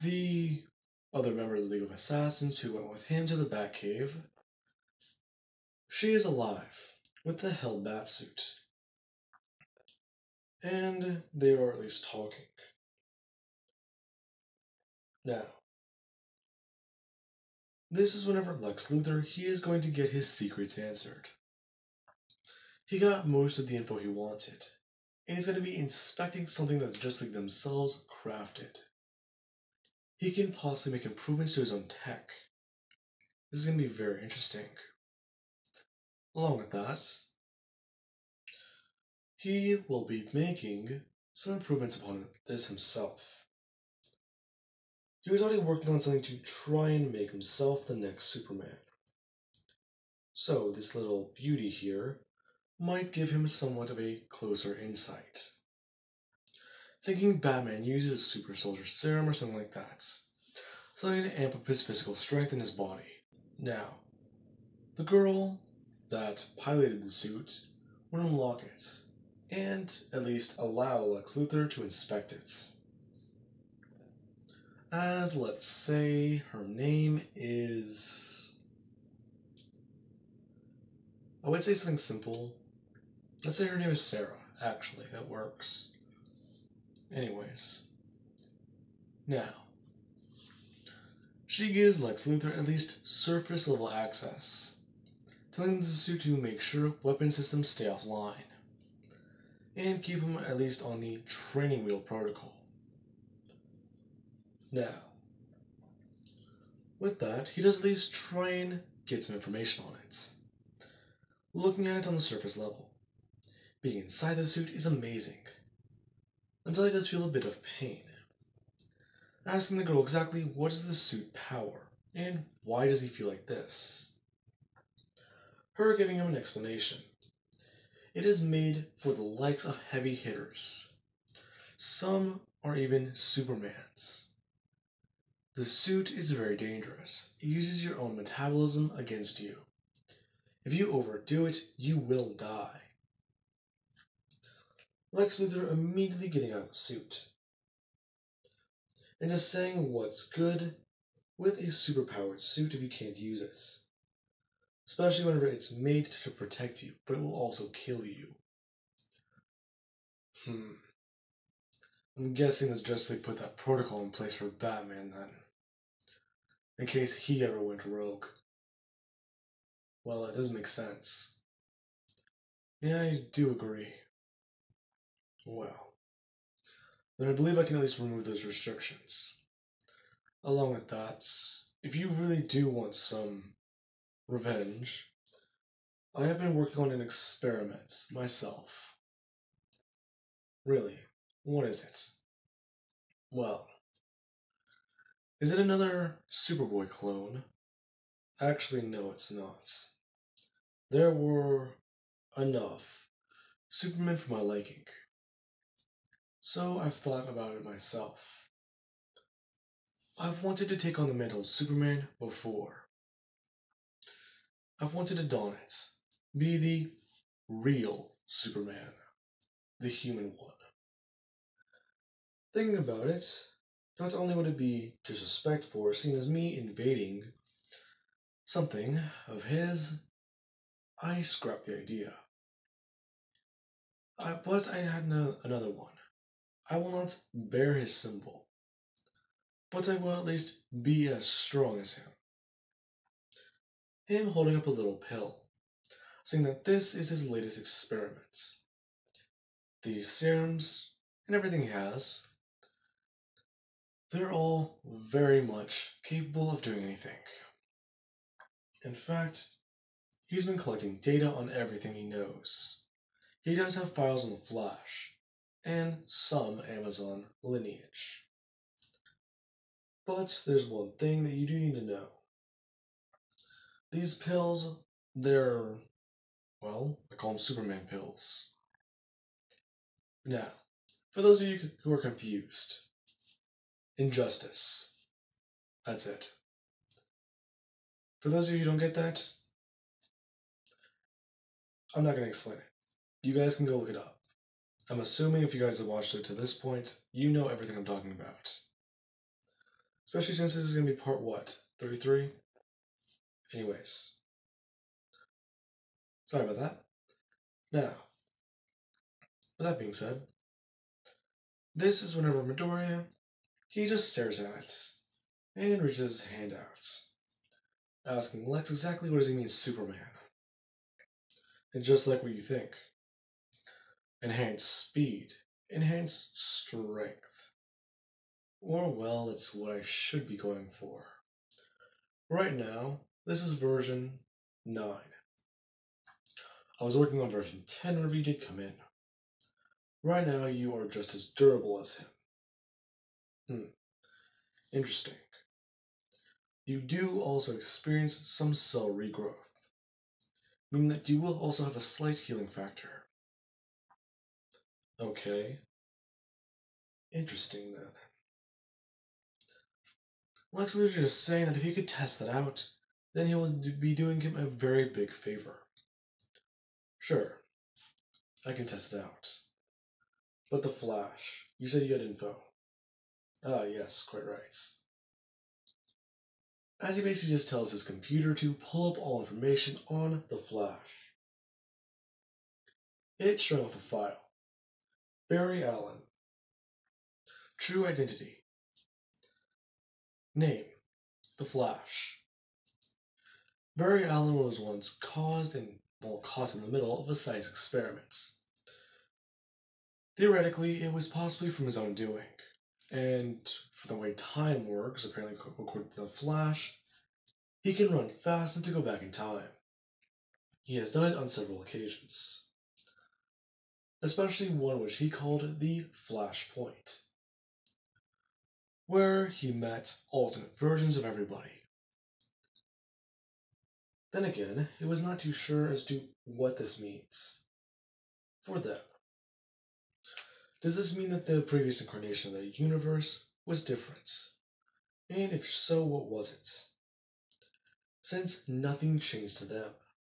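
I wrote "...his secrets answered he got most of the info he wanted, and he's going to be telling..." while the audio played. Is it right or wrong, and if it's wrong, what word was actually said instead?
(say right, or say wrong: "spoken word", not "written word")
wrong: "inspecting", not "telling".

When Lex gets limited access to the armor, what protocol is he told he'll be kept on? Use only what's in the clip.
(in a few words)
training wheel protocol.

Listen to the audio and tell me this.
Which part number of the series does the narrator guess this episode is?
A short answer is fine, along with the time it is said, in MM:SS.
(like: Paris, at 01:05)
33, at 05:01.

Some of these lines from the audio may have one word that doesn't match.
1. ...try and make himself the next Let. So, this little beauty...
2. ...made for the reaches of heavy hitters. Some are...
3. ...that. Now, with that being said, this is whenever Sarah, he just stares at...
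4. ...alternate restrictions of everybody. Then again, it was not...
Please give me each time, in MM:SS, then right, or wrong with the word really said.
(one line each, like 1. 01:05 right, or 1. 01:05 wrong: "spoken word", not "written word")
1. 00:46 wrong: "Superman", not "Let"
2. 02:08 wrong: "likes", not "reaches"
3. 05:06 wrong: "Midoriya", not "Sarah"
4. 07:00 wrong: "versions", not "restrictions".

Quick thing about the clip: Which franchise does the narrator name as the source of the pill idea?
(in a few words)
Injustice.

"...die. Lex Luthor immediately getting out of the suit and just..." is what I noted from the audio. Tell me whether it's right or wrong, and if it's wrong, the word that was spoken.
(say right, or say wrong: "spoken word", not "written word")
right.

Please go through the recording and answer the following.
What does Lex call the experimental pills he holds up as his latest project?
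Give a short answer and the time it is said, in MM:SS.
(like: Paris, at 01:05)
Superman pills, at 04:37.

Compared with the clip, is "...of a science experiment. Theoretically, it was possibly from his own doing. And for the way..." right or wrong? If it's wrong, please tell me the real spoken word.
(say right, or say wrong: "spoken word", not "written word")
right.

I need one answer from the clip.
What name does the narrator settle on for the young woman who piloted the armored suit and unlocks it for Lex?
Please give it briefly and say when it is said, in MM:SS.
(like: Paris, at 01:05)
Sarah, at 01:24.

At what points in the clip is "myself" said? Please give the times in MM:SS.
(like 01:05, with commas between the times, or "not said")
03:08, 03:27.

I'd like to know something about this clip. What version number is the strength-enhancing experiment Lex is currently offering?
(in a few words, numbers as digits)
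9.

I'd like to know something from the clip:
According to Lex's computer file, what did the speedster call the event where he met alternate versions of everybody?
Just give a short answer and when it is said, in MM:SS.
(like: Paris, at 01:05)
Flashpoint, at 06:55.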